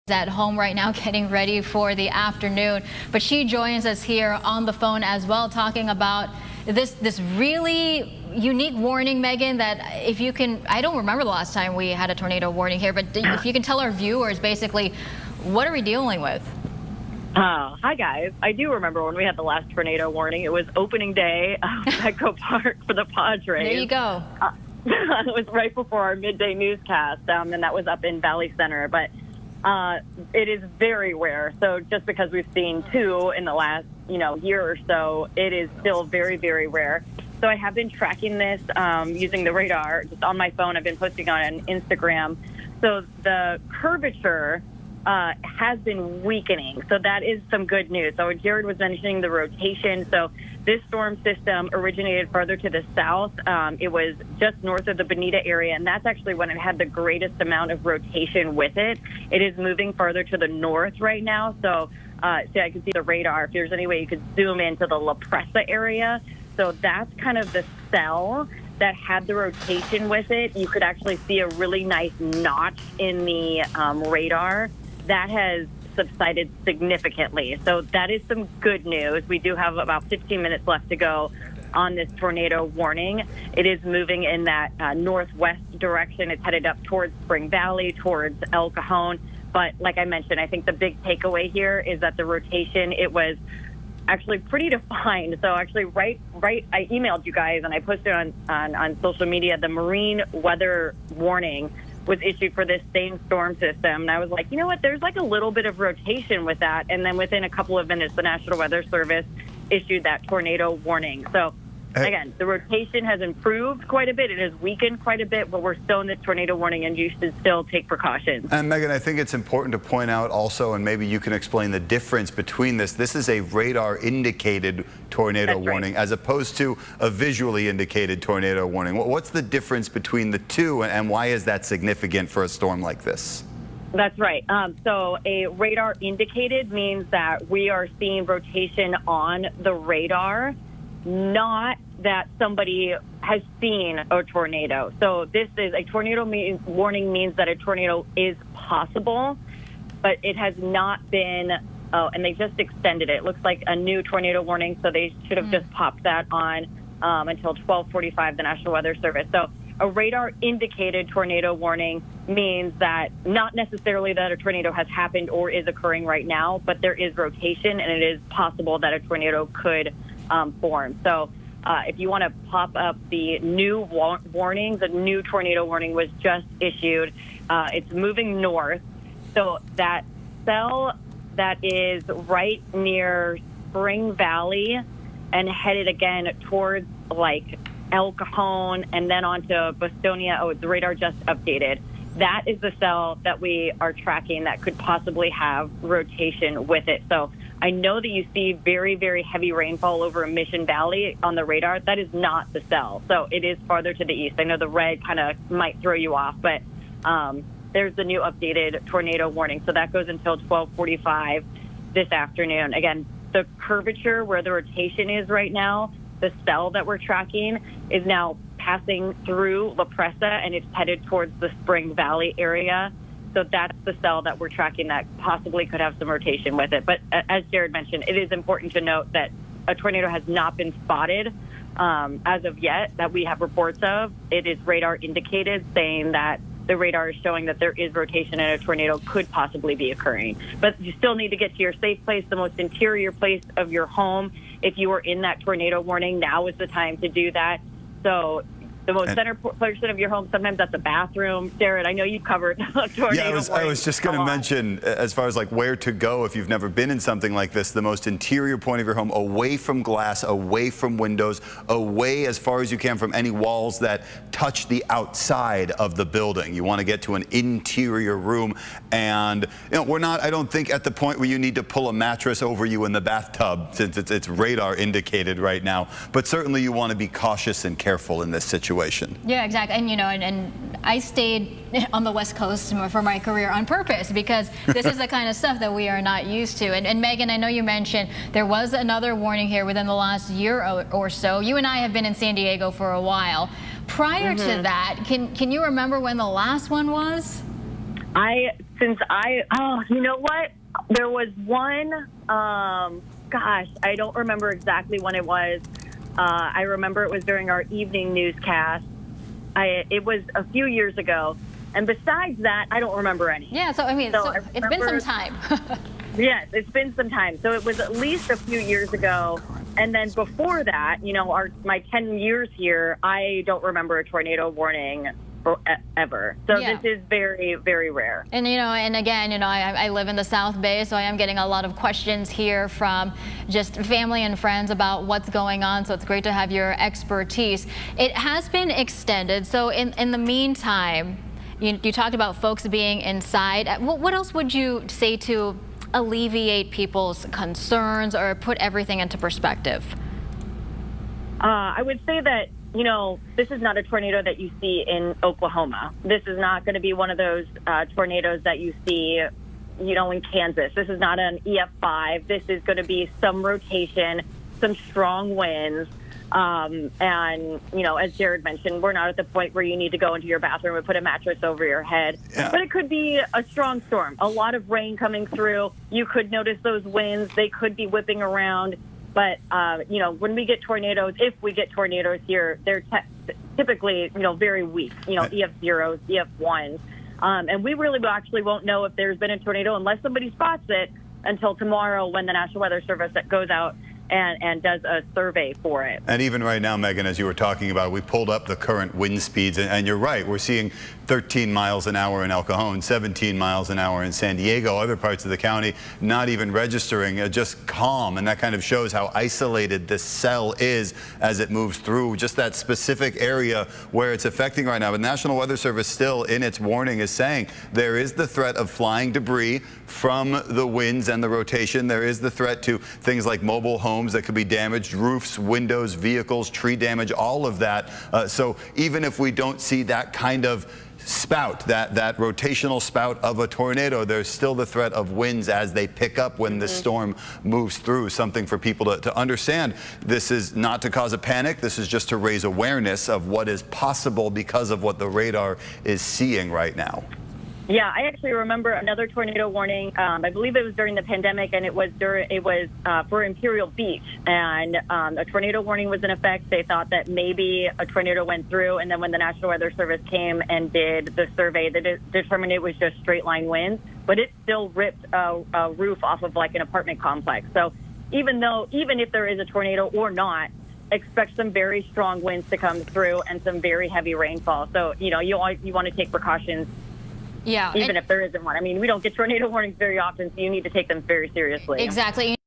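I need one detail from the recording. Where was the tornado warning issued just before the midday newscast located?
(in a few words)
Valley Center.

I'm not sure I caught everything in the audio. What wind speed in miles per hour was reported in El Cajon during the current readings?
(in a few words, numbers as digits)
13.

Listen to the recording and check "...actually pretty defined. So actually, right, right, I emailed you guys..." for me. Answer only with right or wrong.
right.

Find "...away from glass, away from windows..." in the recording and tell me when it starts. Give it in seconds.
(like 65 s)
259 s.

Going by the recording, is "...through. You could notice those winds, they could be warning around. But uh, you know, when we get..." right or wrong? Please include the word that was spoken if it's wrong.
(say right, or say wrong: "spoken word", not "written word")
wrong: "whipping", not "warning".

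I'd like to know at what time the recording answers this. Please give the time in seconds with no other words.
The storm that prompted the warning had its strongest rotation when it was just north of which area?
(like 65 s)
55 s.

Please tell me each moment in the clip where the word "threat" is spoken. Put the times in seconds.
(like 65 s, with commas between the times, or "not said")
418 s, 422 s, 434 s.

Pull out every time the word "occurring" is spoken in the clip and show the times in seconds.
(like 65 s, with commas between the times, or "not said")
165 s, 239 s.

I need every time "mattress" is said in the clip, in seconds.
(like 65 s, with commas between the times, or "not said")
271 s, 371 s.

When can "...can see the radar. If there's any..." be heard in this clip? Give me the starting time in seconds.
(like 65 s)
62 s.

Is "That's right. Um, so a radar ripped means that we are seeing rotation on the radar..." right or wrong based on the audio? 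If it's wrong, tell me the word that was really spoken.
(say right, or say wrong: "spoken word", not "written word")
wrong: "indicated", not "ripped".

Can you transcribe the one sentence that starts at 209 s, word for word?
So that goes until 1245 this afternoon.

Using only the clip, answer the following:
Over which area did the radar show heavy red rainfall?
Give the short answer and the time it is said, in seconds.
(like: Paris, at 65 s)
Mission Valley, at 200 s.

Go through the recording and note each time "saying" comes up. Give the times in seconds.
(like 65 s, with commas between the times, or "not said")
235 s, 417 s.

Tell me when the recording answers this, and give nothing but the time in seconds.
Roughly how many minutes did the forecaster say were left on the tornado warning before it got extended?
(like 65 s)
80 s.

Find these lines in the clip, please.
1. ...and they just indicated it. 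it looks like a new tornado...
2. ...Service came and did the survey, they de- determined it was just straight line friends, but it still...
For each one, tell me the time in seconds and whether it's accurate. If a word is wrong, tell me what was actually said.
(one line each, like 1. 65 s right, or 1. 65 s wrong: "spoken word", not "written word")
1. 152 s wrong: "extended", not "indicated"
2. 459 s wrong: "winds", not "friends".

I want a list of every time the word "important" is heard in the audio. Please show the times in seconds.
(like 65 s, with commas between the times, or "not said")
119 s, 228 s.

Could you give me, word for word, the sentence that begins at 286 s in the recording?
And, and, Megan, I know you mentioned there was another warning here within the last year or, so.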